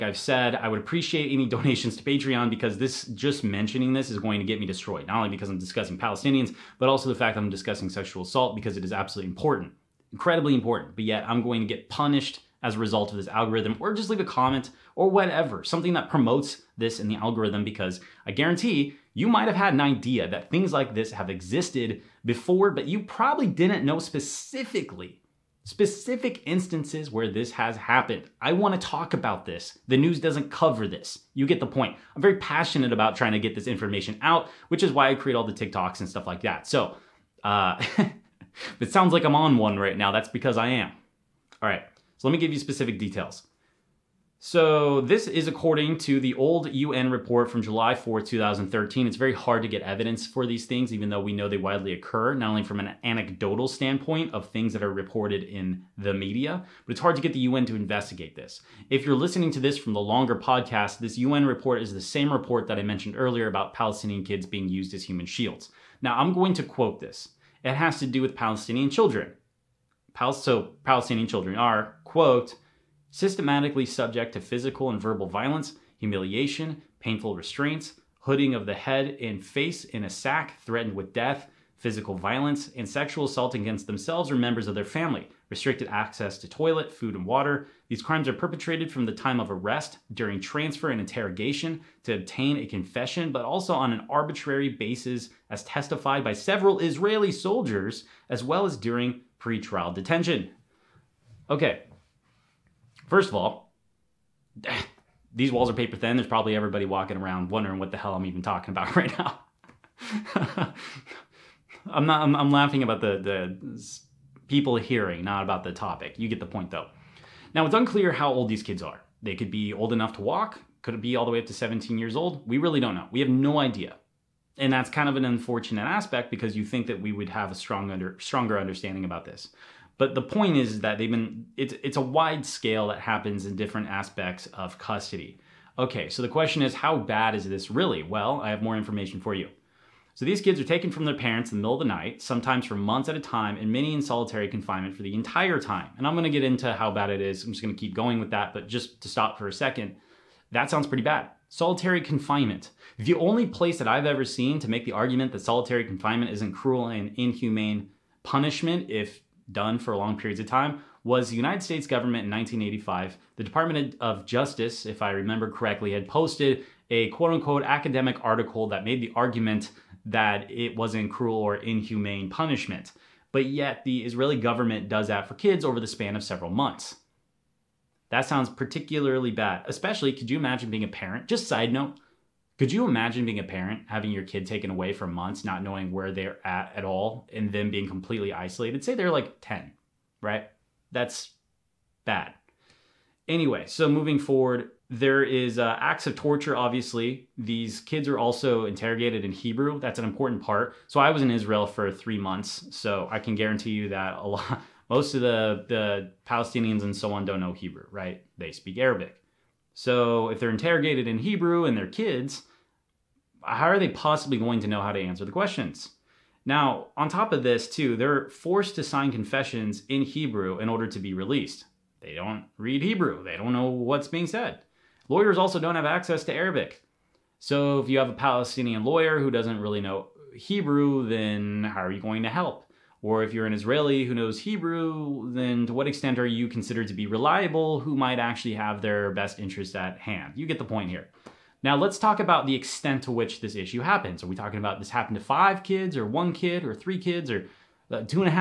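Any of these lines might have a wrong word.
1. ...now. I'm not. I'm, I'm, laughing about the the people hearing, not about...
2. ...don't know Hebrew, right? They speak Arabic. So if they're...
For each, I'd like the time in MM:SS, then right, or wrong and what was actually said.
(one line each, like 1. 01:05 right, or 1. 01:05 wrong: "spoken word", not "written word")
1. 01:49 right
2. 03:27 right.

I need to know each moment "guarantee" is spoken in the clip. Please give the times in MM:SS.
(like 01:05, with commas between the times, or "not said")
00:18, 03:23.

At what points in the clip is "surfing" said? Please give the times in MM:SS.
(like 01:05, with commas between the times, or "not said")
not said.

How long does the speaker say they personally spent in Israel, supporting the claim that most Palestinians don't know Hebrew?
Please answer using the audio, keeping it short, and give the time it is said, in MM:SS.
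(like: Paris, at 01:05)
3 months, at 03:21.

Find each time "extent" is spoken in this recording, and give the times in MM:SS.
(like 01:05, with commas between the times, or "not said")
03:55, 04:02.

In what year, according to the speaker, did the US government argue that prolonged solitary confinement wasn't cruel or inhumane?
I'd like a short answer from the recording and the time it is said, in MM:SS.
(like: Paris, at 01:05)
1985, at 02:42.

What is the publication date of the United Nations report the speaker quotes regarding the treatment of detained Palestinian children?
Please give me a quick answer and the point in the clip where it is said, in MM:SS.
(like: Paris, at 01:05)
July 4, 2013, at 00:47.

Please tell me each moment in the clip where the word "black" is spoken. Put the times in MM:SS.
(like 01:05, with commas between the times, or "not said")
not said.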